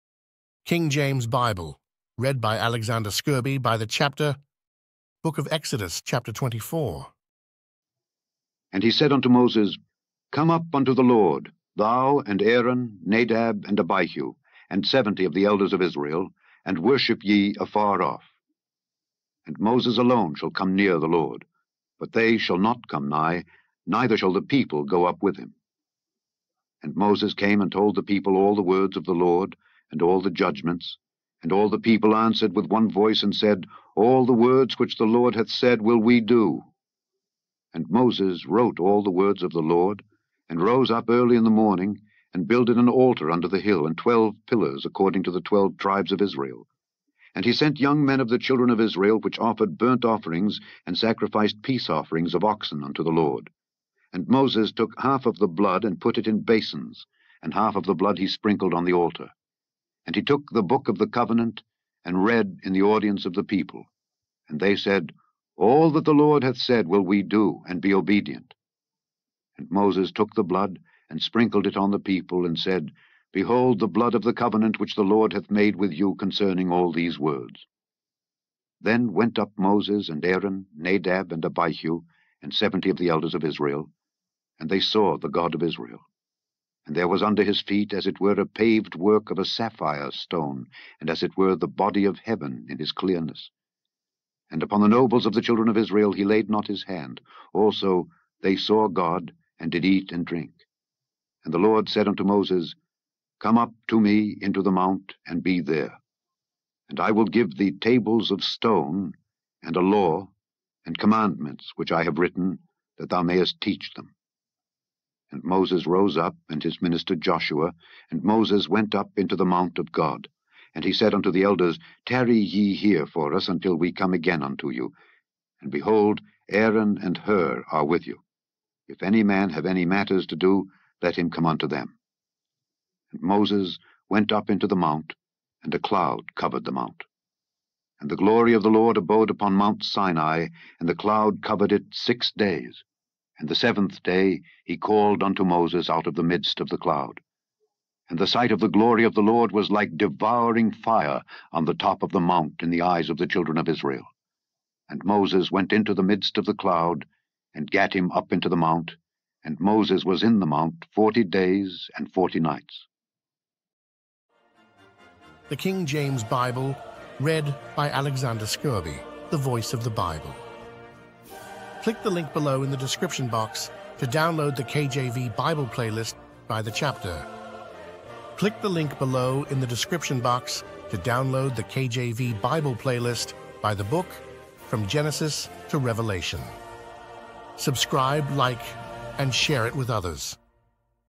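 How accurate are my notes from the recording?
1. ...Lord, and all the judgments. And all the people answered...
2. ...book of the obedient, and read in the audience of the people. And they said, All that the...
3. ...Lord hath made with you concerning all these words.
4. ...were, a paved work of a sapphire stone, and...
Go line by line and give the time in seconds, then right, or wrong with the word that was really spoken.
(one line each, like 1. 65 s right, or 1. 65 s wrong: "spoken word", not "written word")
1. 29 s right
2. 60 s wrong: "covenant", not "obedient"
3. 75 s right
4. 88 s right.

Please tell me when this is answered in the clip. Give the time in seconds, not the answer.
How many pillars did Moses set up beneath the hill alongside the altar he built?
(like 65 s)
43 s.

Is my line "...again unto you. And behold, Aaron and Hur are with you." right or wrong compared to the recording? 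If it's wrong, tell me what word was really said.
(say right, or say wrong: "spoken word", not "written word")
right.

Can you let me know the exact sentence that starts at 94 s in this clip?
And upon the nobles of the children of Israel he laid not his hand.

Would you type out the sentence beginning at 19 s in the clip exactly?
And Moses alone shall come near the Lord, but they shall not come nigh, neither shall the people go up with him.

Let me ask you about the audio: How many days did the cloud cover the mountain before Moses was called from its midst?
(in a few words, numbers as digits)
6.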